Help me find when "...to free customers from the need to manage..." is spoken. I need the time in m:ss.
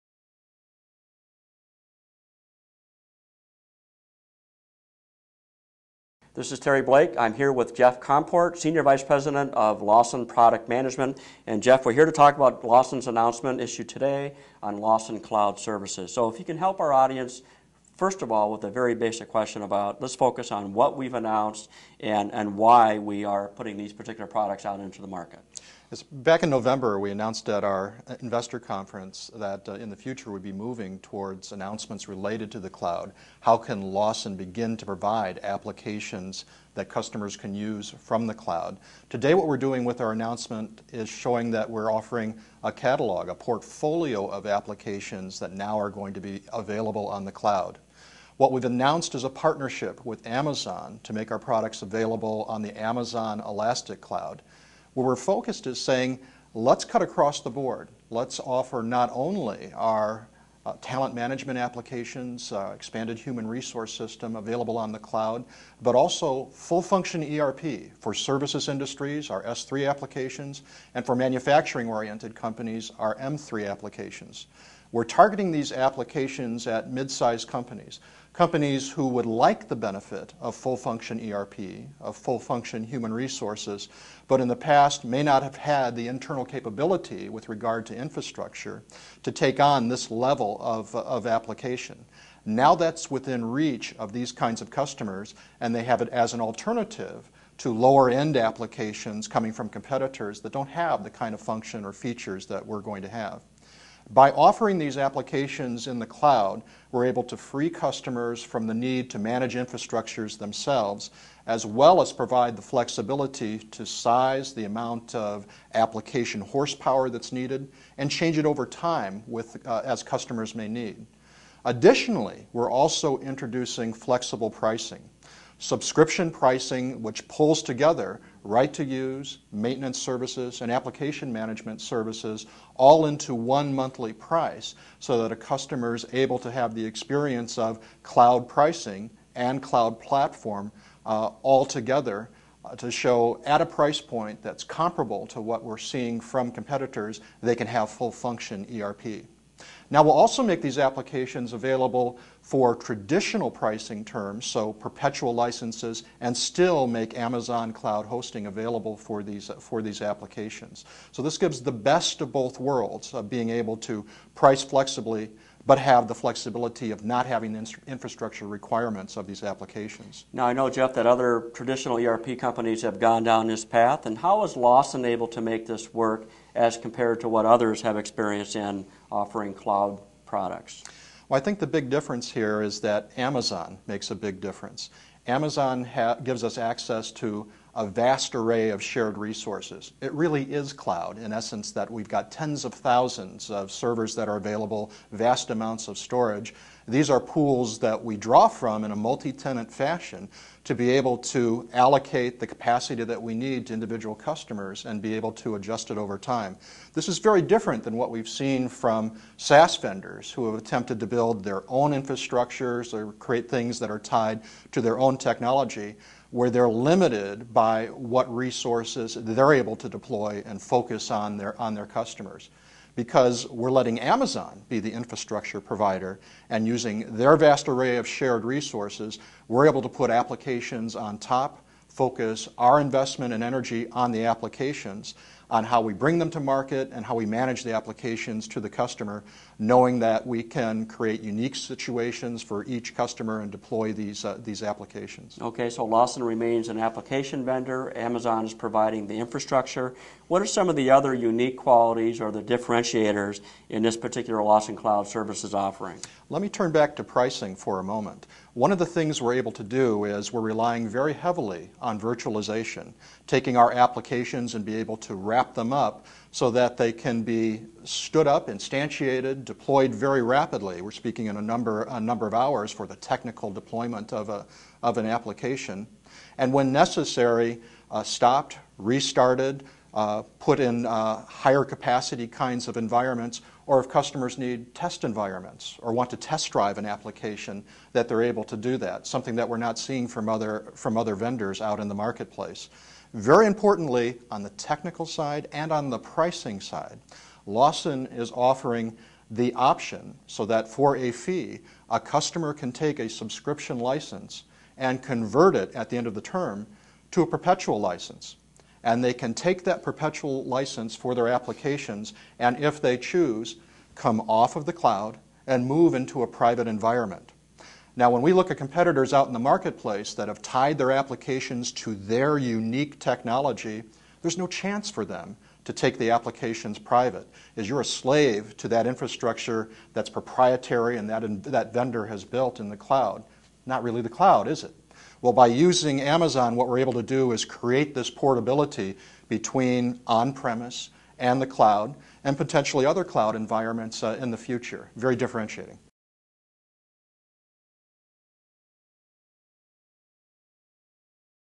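1:47.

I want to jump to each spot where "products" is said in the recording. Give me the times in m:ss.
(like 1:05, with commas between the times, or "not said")
0:10, 0:24, 0:51, 3:00.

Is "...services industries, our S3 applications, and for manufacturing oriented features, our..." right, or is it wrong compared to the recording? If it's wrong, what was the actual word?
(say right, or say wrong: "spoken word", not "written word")
wrong: "companies", not "features".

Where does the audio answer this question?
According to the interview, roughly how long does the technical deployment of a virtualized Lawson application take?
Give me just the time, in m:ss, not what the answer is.
4:31.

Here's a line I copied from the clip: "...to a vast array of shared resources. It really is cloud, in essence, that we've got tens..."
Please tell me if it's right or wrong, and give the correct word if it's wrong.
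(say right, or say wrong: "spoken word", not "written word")
right.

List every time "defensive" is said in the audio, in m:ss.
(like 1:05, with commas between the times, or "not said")
not said.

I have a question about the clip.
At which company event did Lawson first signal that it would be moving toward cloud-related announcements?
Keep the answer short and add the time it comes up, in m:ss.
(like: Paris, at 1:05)
Investor conference, at 0:28.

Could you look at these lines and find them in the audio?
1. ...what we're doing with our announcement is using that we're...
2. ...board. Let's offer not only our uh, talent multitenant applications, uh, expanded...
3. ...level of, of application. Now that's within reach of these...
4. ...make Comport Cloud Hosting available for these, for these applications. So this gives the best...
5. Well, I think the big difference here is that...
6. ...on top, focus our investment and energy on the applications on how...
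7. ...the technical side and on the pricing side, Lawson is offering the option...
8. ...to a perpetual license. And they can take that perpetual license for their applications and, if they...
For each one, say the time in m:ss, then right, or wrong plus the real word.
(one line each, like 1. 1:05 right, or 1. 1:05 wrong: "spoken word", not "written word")
1. 0:39 wrong: "showing", not "using"
2. 0:57 wrong: "management", not "multitenant"
3. 1:30 right
4. 2:36 wrong: "Amazon", not "Comport"
5. 3:01 right
6. 3:50 right
7. 4:54 right
8. 5:07 right.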